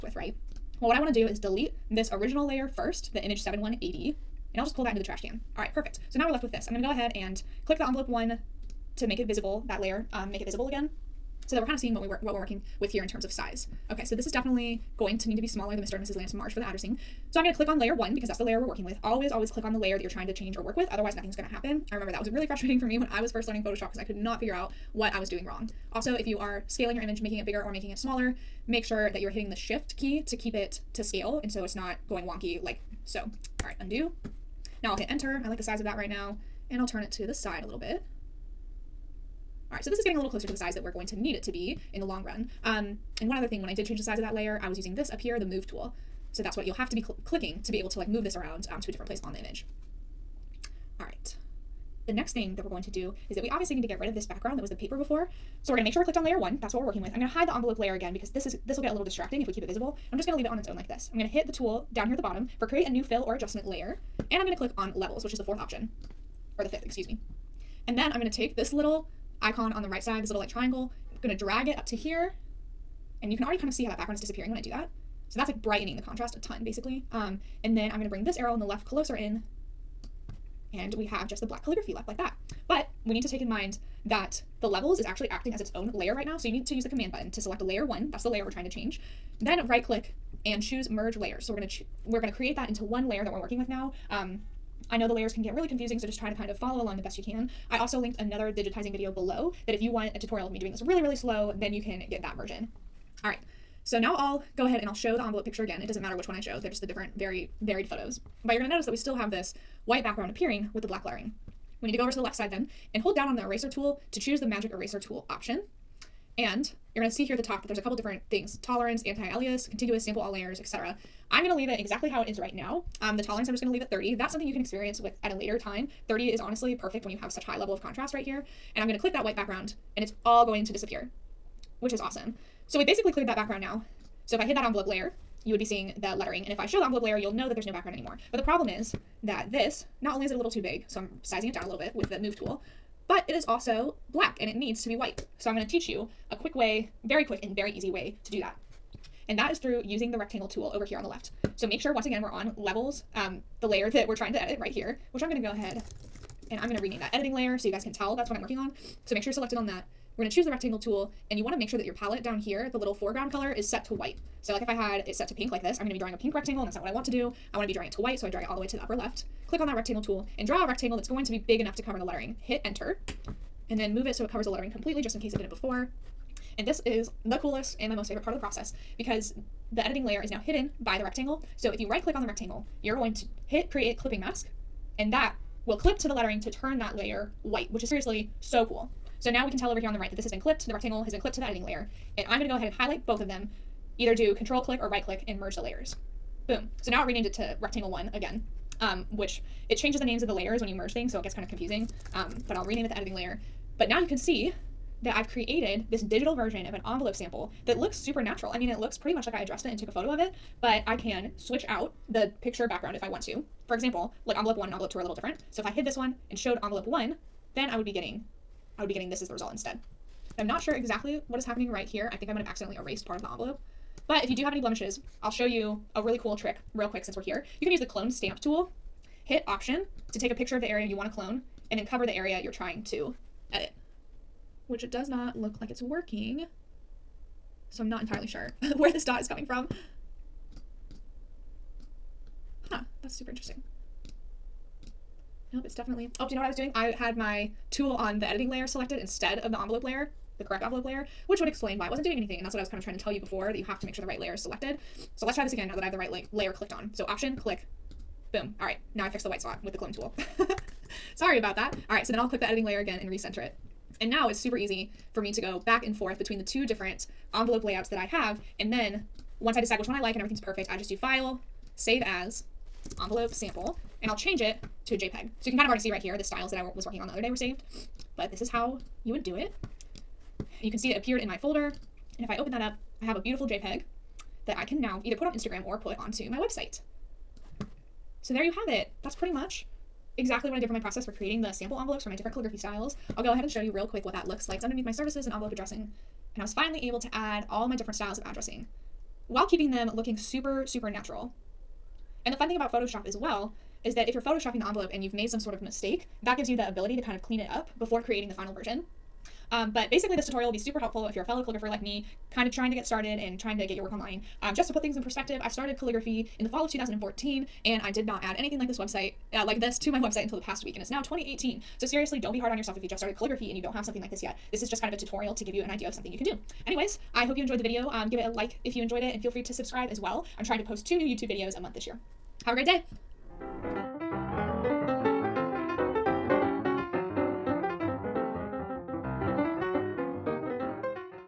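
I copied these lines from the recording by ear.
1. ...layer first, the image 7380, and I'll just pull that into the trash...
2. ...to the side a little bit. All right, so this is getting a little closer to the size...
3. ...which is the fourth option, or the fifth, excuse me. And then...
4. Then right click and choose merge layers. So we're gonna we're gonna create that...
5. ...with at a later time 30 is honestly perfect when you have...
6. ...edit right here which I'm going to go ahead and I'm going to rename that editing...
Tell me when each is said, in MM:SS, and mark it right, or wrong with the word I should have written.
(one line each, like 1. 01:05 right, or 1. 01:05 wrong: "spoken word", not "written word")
1. 00:02 wrong: "7180", not "7380"
2. 00:37 right
3. 01:05 right
4. 01:29 right
5. 02:04 right
6. 02:34 right.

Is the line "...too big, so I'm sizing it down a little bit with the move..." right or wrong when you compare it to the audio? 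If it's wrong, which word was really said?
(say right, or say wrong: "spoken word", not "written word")
right.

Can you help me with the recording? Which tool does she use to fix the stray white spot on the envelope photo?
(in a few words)
clone stamp tool.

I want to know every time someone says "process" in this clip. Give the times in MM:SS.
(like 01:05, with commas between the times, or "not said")
02:58, 04:50.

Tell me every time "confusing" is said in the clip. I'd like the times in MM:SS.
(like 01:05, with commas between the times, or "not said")
01:35, 03:21.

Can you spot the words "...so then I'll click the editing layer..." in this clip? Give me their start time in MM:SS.
04:22.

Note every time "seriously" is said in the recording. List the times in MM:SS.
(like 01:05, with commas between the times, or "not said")
03:07, 05:21.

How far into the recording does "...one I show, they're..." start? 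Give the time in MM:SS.
01:46.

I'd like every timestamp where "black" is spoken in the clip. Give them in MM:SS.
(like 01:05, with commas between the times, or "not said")
01:21, 01:50, 02:24.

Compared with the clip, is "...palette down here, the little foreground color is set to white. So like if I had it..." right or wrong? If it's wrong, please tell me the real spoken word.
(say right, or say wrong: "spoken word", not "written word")
right.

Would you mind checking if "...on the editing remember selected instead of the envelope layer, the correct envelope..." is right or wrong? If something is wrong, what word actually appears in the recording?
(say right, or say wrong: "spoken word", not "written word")
wrong: "layer", not "remember".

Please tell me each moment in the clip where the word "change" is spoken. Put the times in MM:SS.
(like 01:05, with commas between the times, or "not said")
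00:20, 00:43, 01:28, 03:19, 04:34.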